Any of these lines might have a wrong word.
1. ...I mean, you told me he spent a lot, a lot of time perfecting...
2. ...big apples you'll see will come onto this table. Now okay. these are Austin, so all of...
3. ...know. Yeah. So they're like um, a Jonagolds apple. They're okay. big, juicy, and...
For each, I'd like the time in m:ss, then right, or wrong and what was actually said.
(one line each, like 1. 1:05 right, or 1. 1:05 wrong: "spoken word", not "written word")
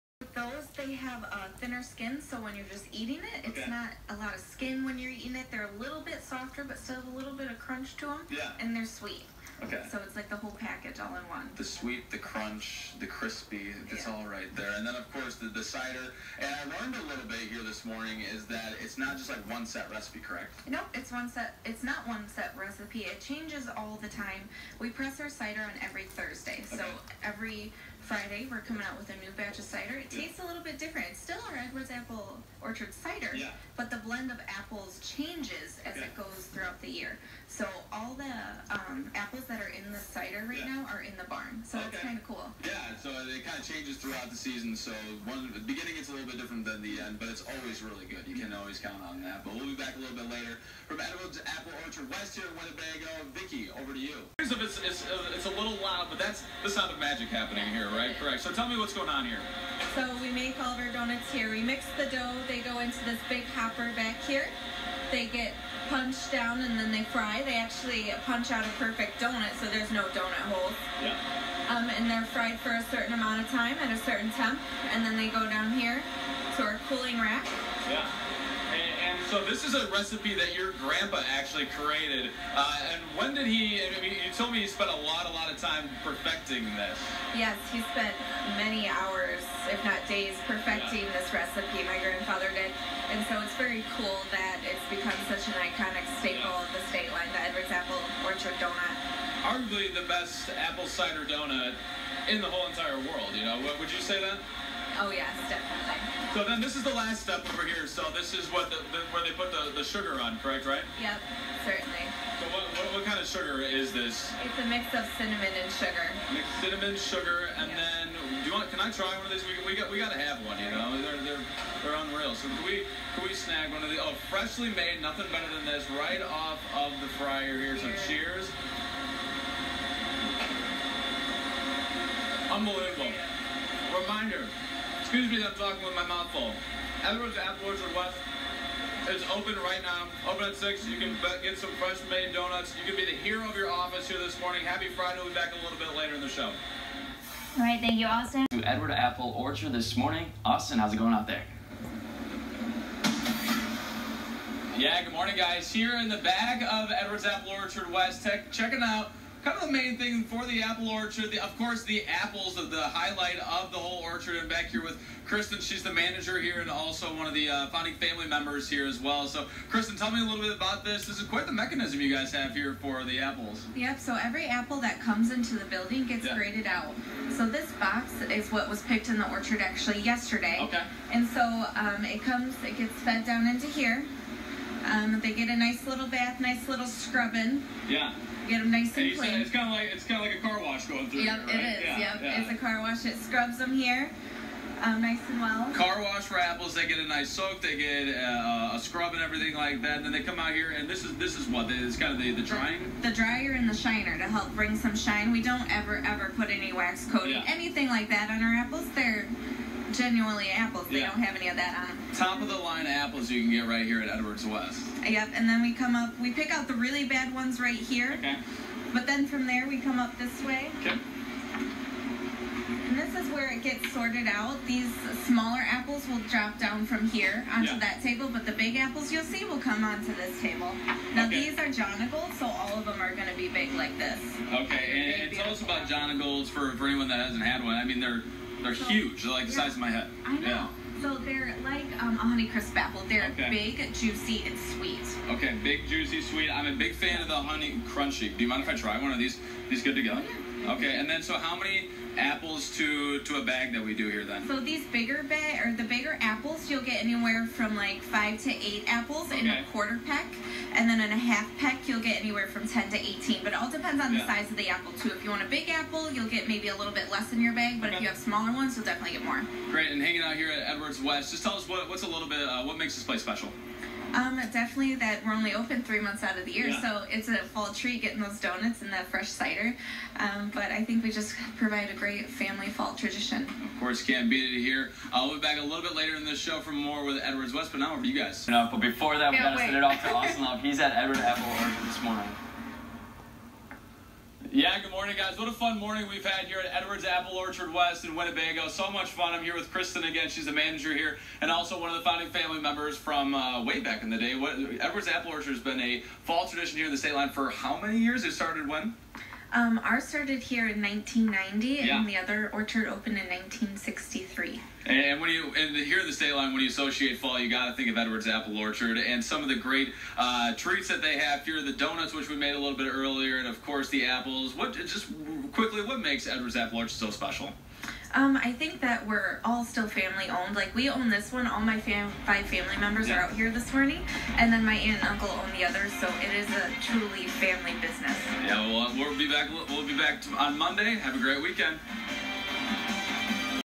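1. 1:23 right
2. 3:48 wrong: "Jonagolds", not "Austin"
3. 4:00 wrong: "Honeycrisp", not "Jonagolds".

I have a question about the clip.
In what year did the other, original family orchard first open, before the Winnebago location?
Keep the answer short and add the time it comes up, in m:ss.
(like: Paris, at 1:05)
1963, at 5:13.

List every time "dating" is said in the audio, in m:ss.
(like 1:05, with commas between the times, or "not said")
not said.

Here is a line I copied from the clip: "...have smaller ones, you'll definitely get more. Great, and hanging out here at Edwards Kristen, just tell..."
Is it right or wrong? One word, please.
wrong.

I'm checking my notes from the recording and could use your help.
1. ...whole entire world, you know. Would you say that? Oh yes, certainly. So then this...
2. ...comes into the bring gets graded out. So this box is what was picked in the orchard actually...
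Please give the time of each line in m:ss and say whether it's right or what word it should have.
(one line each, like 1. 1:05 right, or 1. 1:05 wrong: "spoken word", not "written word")
1. 1:42 wrong: "definitely", not "certainly"
2. 2:55 wrong: "building", not "bring".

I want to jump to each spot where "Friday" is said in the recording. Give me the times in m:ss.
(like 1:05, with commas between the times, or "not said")
0:28, 2:24.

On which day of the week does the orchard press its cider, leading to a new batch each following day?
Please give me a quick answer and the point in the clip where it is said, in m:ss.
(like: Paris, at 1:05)
Thursday, at 0:26.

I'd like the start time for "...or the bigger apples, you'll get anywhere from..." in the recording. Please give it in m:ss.
4:15.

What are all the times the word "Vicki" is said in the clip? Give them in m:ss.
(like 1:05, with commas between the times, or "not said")
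0:53.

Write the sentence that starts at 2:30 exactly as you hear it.
Austin, how's it going out there?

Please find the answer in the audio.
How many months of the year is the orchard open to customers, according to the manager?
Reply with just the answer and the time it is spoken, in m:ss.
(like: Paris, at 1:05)
3, at 4:35.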